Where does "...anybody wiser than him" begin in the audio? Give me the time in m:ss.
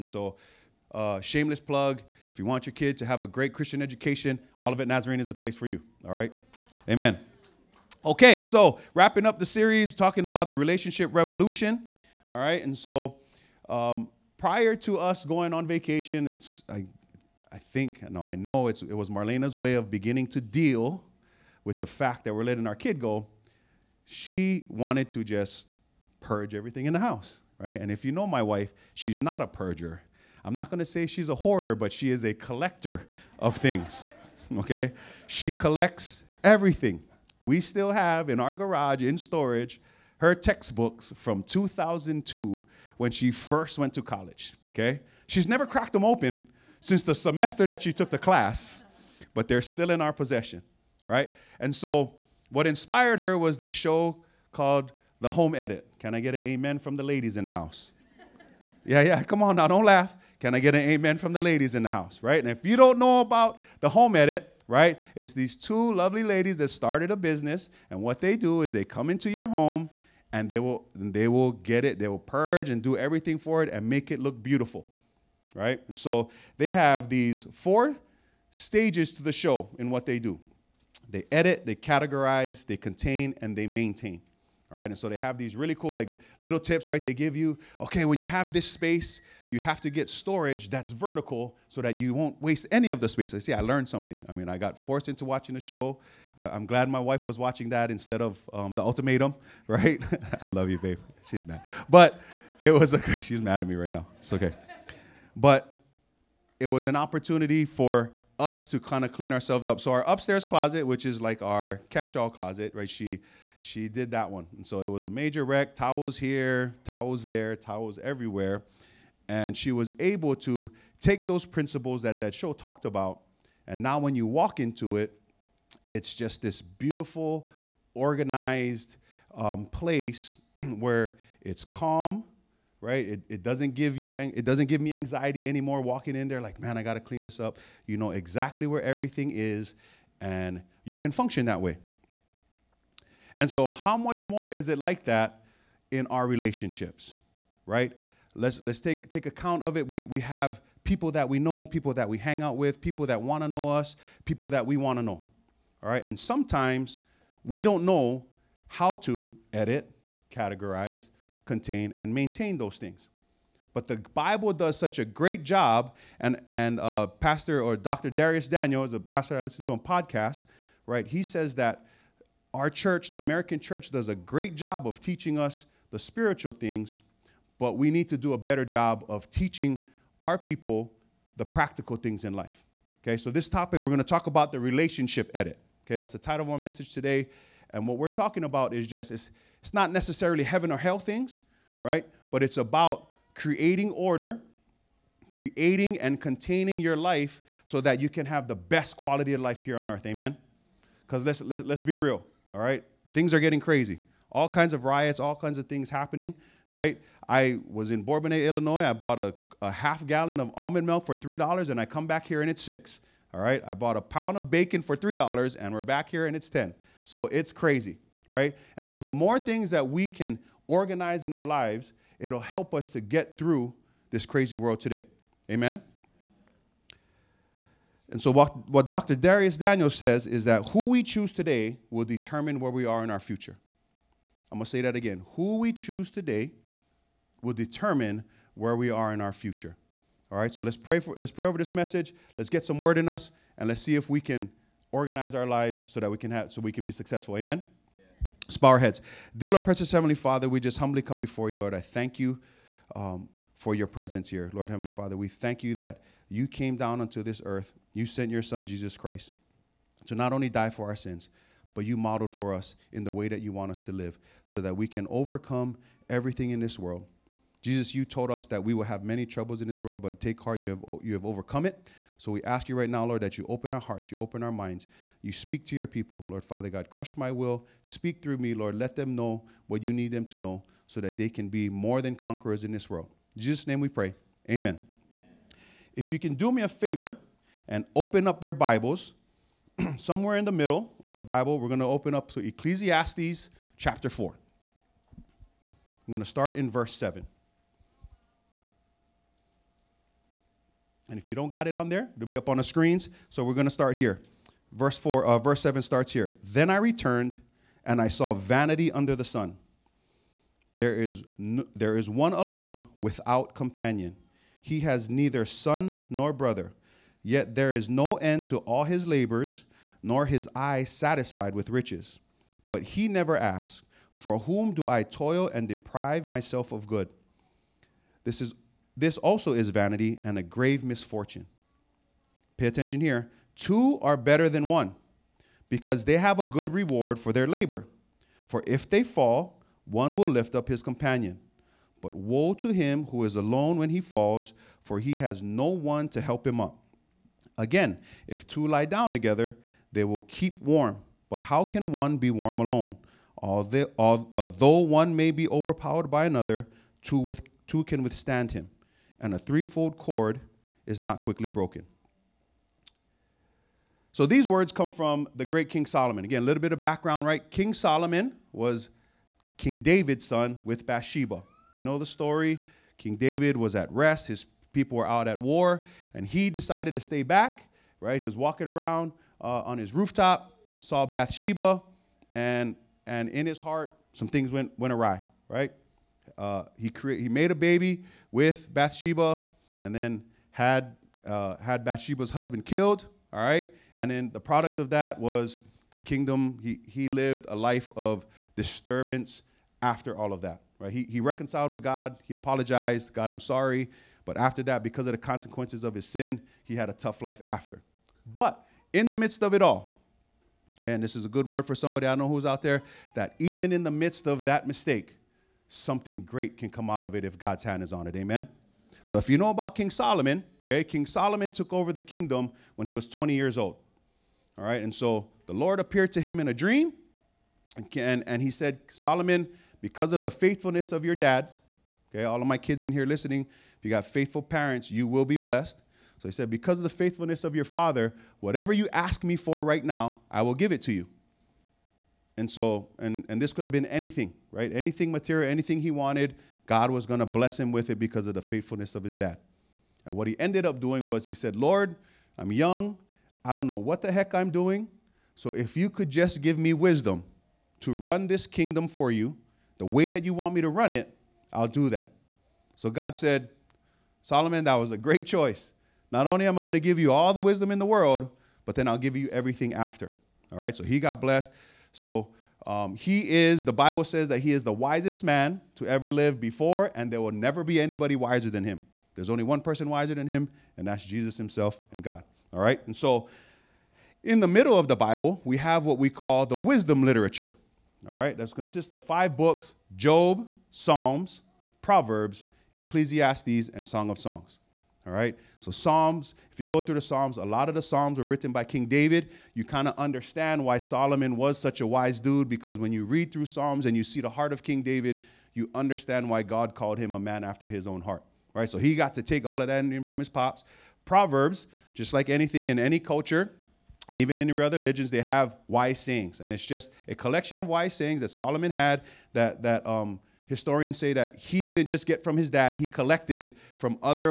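7:57.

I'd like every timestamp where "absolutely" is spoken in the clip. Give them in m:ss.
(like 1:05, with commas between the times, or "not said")
not said.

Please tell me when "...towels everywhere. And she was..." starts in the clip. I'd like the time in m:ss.
1:57.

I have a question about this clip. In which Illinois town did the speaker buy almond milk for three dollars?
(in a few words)
Bourbonnais.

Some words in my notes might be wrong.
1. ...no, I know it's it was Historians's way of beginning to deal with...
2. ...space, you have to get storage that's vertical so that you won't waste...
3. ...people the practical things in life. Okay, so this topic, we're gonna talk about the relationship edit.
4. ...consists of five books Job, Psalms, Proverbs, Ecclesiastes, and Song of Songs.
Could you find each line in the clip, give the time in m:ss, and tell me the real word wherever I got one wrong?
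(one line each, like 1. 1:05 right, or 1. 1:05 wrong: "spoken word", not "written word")
1. 0:18 wrong: "Marlena", not "Historians"
2. 1:28 right
3. 3:00 right
4. 8:08 right.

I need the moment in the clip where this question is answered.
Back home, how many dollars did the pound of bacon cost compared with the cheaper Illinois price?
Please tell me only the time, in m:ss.
3:36.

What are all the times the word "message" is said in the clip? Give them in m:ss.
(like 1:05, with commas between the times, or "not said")
3:06, 4:01.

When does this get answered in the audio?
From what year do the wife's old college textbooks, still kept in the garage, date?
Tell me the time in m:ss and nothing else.
0:41.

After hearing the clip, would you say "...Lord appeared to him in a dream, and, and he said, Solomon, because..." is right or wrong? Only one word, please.
right.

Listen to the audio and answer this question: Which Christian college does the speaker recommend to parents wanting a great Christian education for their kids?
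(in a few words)
Olivet Nazarene.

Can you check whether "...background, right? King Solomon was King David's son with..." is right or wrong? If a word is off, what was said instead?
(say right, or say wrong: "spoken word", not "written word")
right.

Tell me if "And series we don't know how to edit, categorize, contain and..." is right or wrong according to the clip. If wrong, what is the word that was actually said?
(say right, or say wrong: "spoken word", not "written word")
wrong: "sometimes", not "series".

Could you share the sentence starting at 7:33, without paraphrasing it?
I don't know what the heck I'm doing.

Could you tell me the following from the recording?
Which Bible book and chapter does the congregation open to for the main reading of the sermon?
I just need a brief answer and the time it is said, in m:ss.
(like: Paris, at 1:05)
Ecclesiastes 4, at 4:52.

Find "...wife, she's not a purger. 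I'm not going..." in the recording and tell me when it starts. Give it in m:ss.
0:28.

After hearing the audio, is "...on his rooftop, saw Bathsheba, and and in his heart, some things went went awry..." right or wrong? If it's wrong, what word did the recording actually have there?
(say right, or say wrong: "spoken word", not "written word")
right.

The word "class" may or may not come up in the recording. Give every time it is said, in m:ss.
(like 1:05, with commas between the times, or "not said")
0:48.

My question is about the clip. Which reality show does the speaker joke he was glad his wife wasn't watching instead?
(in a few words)
The Ultimatum.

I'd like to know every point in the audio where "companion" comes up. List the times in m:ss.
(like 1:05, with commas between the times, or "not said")
5:13, 5:40.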